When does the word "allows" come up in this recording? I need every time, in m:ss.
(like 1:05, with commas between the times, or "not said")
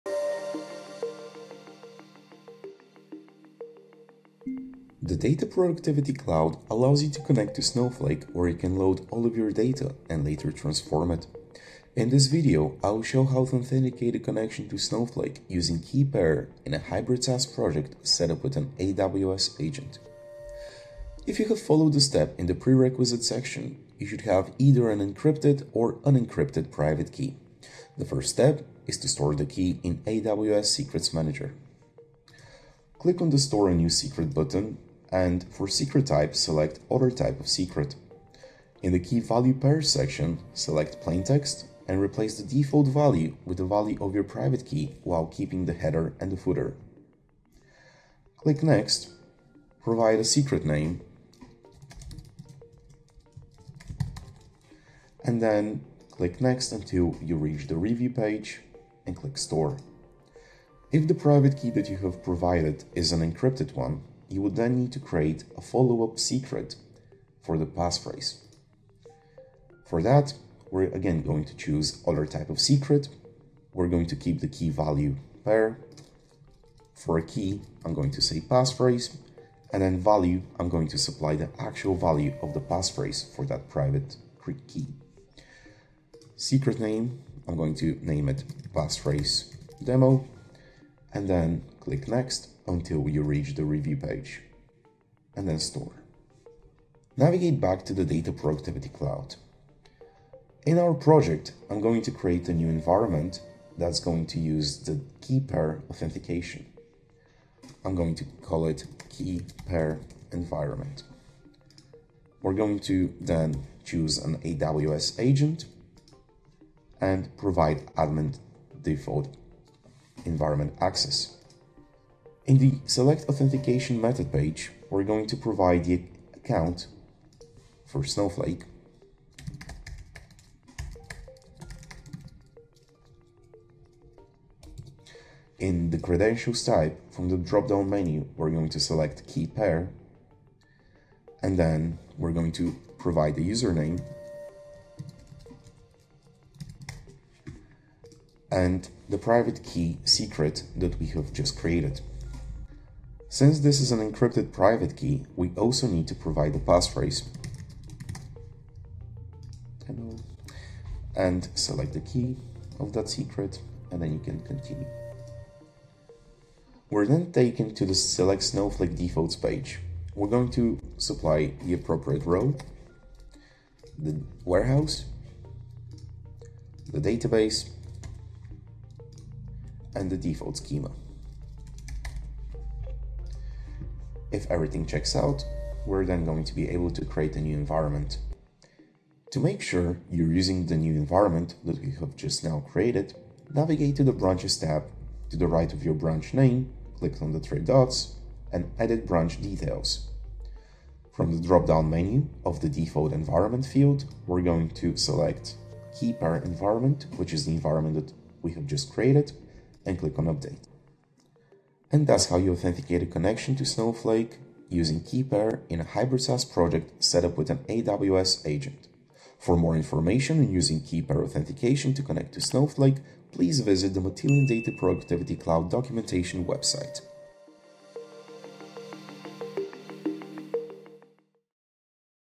0:06.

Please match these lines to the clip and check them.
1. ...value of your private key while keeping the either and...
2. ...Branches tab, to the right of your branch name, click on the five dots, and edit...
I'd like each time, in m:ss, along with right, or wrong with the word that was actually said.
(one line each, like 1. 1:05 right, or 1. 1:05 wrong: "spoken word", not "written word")
1. 0:43 wrong: "header", not "either"
2. 3:14 wrong: "three", not "five".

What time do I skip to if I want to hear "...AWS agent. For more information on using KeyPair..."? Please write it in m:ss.
3:37.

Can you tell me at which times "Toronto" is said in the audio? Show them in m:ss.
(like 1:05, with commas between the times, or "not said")
not said.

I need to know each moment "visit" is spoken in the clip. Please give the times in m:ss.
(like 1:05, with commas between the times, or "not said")
3:43.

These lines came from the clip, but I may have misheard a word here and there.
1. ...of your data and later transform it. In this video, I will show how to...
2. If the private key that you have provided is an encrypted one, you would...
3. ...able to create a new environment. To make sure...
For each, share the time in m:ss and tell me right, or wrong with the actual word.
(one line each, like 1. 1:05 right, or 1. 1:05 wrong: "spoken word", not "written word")
1. 0:09 right
2. 1:00 right
3. 3:06 right.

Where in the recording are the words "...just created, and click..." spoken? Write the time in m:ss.
3:28.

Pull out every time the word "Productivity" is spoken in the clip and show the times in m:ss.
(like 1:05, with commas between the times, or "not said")
0:05, 1:38, 3:44.